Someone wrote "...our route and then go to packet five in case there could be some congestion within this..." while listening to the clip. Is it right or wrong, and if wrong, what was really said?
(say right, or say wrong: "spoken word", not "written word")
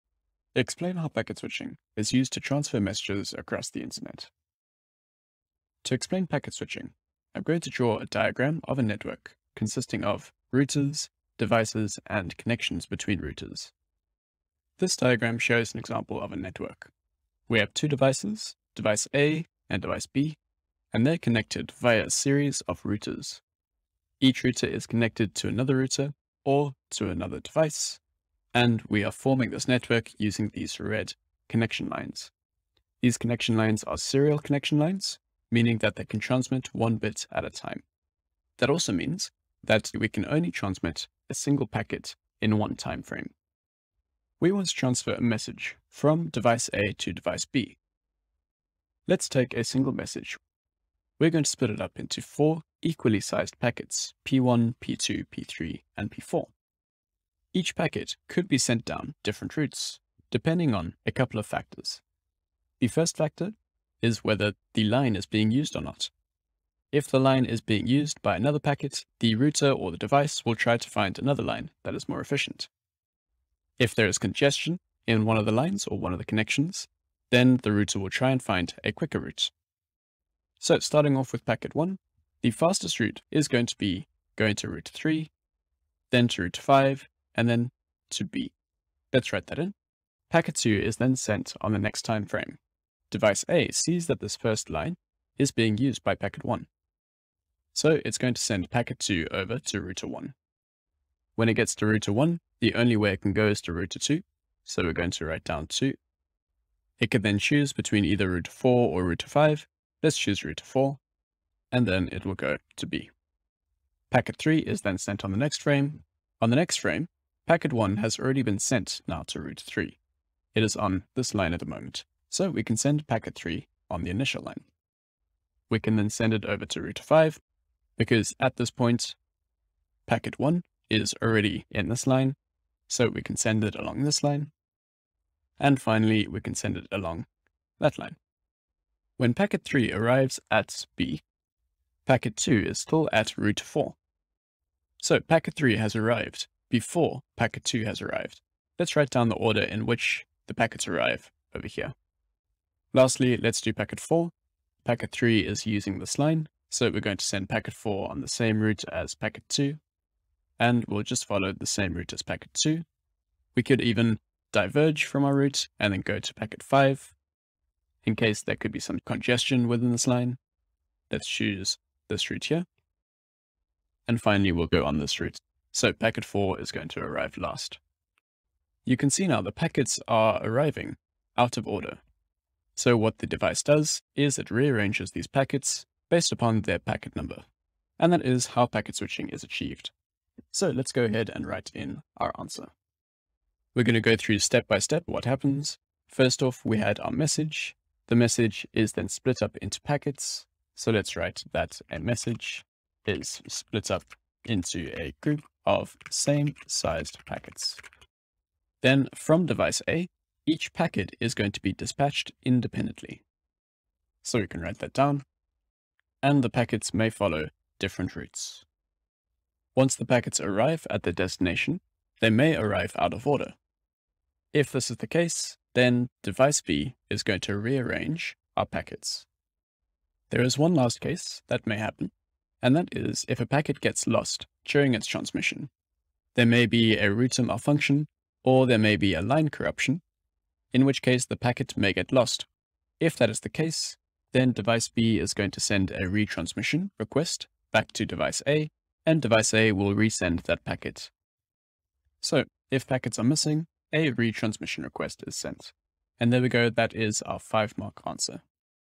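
right.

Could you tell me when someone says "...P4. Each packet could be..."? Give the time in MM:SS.
00:56.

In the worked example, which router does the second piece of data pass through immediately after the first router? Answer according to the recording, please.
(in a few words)
Router 2.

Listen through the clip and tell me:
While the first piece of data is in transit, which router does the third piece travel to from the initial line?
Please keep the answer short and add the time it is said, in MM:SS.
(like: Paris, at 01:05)
Router 5, at 02:06.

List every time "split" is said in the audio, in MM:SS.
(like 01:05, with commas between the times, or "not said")
00:51, 03:19, 03:23.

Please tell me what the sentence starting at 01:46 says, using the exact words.
It can then choose between either router 4 or router 5.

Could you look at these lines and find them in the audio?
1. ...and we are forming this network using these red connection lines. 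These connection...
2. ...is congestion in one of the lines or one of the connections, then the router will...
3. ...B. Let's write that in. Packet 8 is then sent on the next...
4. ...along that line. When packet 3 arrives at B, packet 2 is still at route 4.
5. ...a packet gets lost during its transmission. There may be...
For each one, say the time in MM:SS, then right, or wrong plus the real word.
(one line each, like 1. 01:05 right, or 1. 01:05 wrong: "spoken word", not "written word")
1. 00:28 right
2. 01:14 right
3. 01:28 wrong: "2", not "8"
4. 02:16 right
5. 03:53 right.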